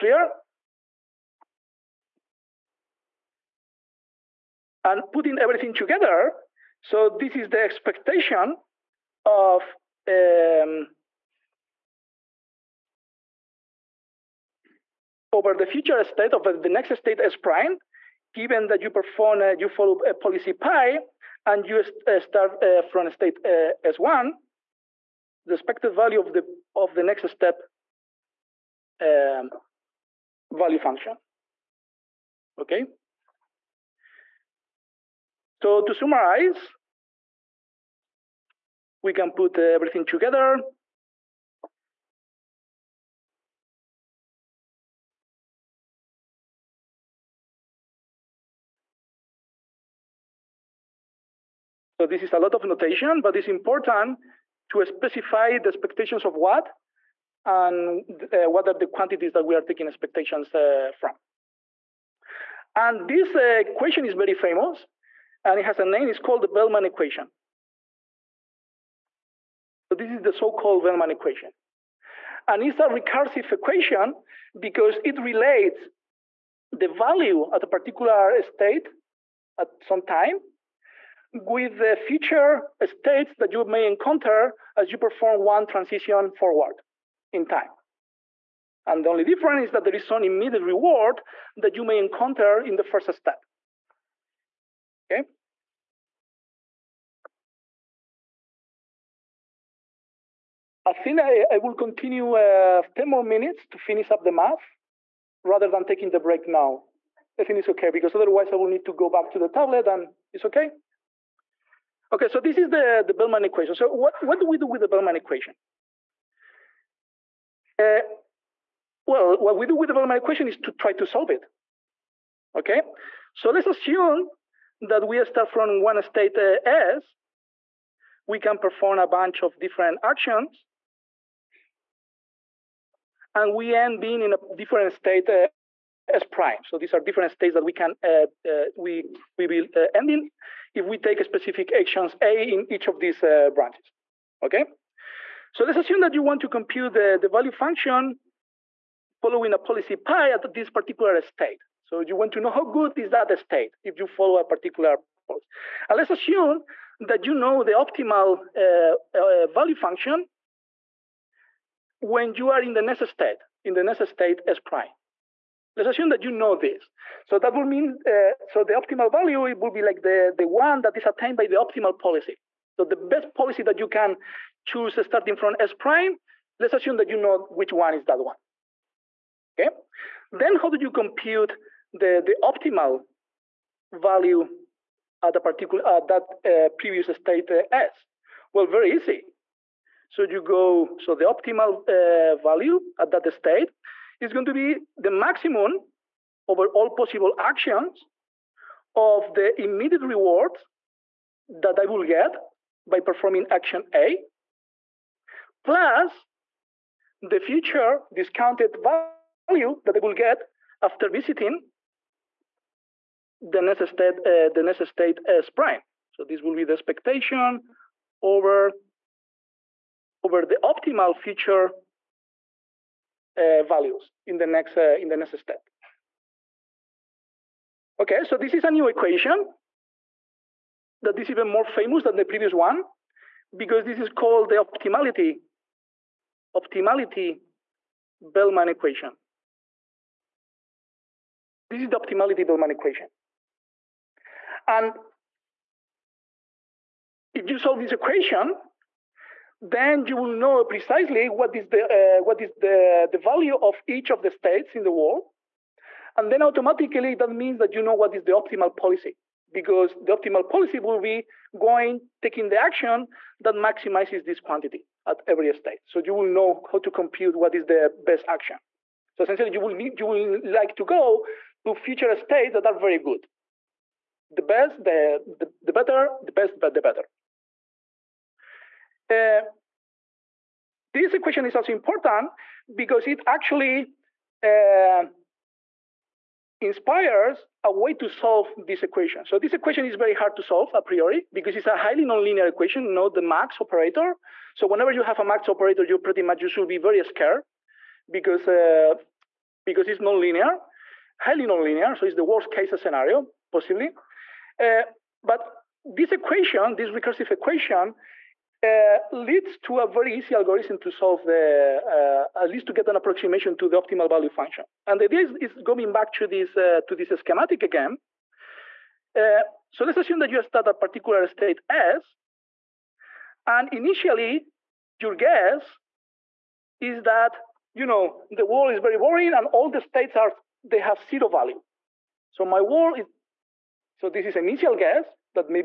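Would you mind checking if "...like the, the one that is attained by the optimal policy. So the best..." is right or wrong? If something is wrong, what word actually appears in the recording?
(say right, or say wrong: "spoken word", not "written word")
right.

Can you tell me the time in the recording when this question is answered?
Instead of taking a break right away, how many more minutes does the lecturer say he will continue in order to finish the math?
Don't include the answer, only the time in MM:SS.
01:42.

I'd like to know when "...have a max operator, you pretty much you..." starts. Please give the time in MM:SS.
04:55.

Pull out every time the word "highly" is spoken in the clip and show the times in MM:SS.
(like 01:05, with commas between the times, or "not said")
04:51, 05:01.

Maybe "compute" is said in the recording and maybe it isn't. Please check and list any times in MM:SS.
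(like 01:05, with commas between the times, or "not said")
02:26, 03:00, 04:26.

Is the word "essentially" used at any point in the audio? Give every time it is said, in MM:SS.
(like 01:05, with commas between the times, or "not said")
04:29.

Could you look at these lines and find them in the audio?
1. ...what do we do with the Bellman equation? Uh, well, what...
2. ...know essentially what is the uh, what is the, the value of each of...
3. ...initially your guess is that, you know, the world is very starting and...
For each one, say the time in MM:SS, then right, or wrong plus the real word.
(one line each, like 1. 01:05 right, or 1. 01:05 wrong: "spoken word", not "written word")
1. 01:54 right
2. 04:10 wrong: "precisely", not "essentially"
3. 05:23 wrong: "boring", not "starting".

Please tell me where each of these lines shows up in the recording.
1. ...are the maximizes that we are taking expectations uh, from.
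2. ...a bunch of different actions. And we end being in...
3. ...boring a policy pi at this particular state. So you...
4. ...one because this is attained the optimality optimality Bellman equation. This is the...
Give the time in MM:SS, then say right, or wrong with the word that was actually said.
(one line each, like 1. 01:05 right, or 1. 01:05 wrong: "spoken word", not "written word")
1. 00:58 wrong: "quantities", not "maximizes"
2. 02:08 right
3. 02:29 wrong: "following", not "boring"
4. 03:52 wrong: "called", not "attained".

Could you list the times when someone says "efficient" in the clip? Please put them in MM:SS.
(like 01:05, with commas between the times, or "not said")
not said.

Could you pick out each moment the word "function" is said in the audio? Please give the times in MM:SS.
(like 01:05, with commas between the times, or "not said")
00:30, 02:27, 02:39, 05:14.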